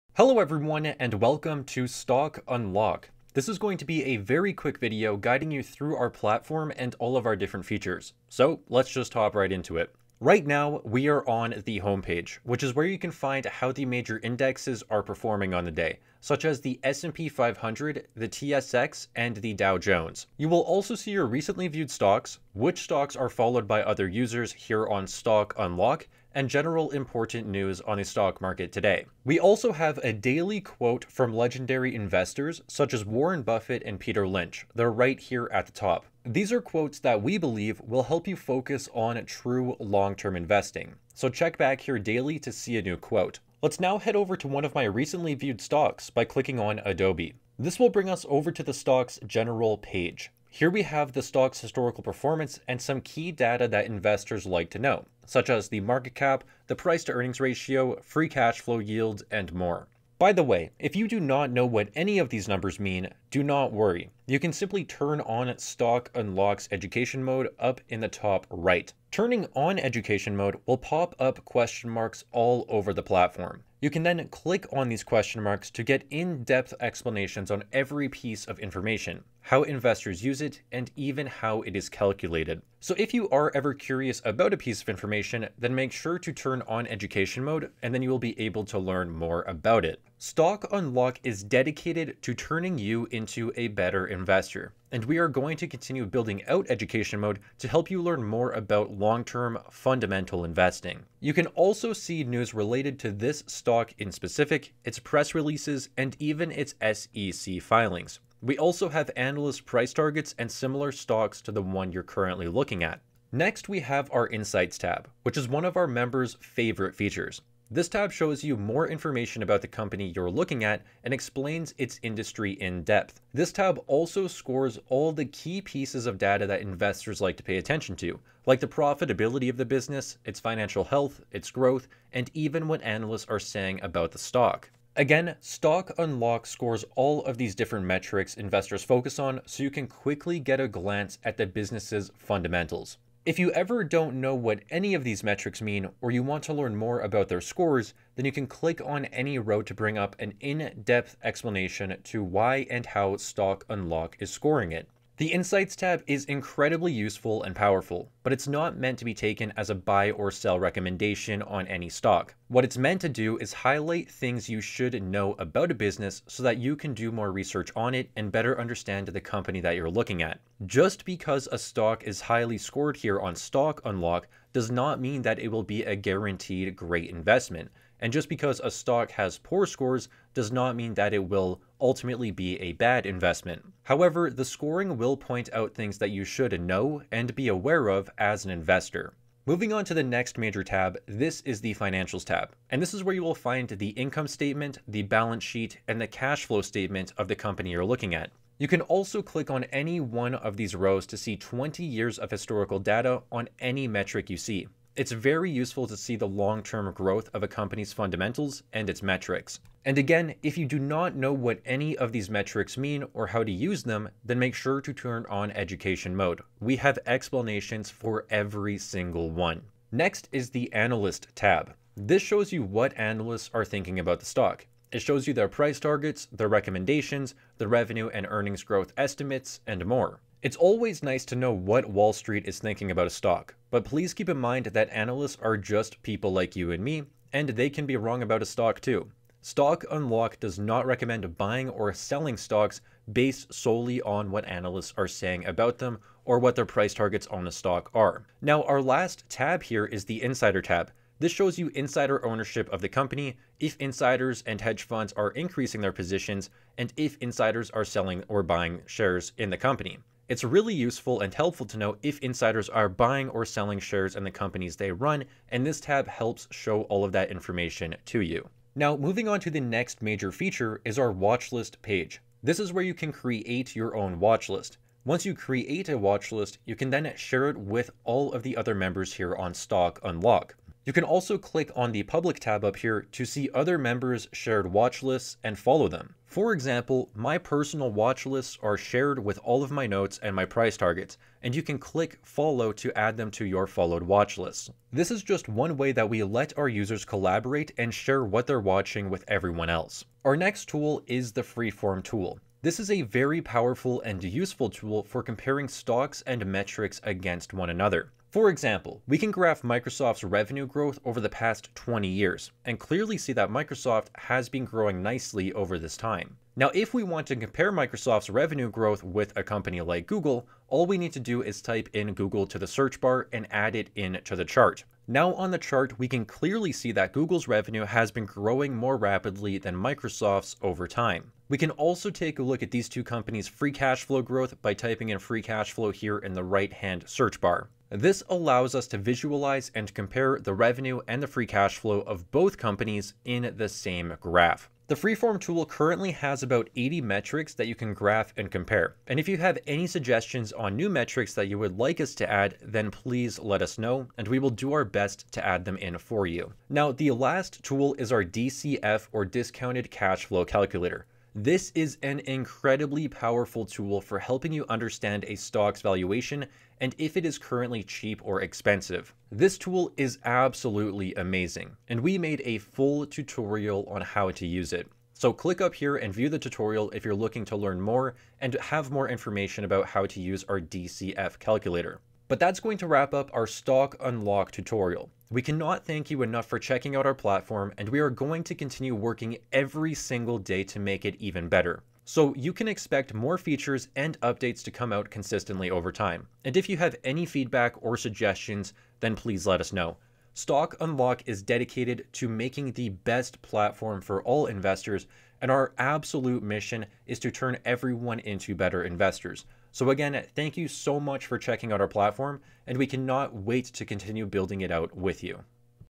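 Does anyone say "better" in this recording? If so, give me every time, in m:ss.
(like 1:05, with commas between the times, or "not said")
1:33, 2:48, 6:31, 6:48.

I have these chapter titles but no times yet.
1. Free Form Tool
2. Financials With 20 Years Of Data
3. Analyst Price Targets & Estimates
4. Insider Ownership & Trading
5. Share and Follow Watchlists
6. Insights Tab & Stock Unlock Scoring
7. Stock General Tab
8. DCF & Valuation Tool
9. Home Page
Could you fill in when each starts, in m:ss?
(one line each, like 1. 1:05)
1. 5:00
2. 3:10
3. 3:40
4. 4:09
5. 4:28
6. 1:54
7. 0:47
8. 5:55
9. 0:11.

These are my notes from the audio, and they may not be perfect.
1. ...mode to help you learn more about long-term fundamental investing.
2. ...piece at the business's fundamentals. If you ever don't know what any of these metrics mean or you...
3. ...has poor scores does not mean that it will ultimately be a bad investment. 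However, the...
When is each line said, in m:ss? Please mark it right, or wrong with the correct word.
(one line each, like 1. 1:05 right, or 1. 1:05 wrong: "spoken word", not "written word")
1. 1:37 right
2. 2:20 wrong: "glance", not "piece"
3. 2:59 right.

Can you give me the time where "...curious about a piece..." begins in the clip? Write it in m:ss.
1:23.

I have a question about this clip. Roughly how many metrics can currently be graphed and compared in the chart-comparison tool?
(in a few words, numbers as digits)
80.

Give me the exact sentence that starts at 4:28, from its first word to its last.
Now, moving on to the next major feature is our watchlist page.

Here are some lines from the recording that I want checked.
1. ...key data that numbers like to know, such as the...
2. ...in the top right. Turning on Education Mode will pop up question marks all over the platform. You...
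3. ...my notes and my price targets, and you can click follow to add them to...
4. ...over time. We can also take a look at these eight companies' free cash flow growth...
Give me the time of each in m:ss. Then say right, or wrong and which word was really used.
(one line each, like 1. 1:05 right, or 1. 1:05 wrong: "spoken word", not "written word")
1. 0:53 wrong: "investors", not "numbers"
2. 1:07 right
3. 4:49 right
4. 5:30 wrong: "two", not "eight".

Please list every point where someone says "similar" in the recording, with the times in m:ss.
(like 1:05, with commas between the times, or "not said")
1:50.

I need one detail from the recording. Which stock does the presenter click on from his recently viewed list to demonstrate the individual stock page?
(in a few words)
Adobe.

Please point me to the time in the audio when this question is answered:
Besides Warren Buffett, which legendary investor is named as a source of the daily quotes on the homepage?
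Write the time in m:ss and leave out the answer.
0:33.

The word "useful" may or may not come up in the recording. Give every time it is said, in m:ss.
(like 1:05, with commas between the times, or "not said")
2:36, 3:25, 4:20, 5:04.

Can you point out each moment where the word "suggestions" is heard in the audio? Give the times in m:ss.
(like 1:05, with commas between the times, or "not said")
5:49, 6:37.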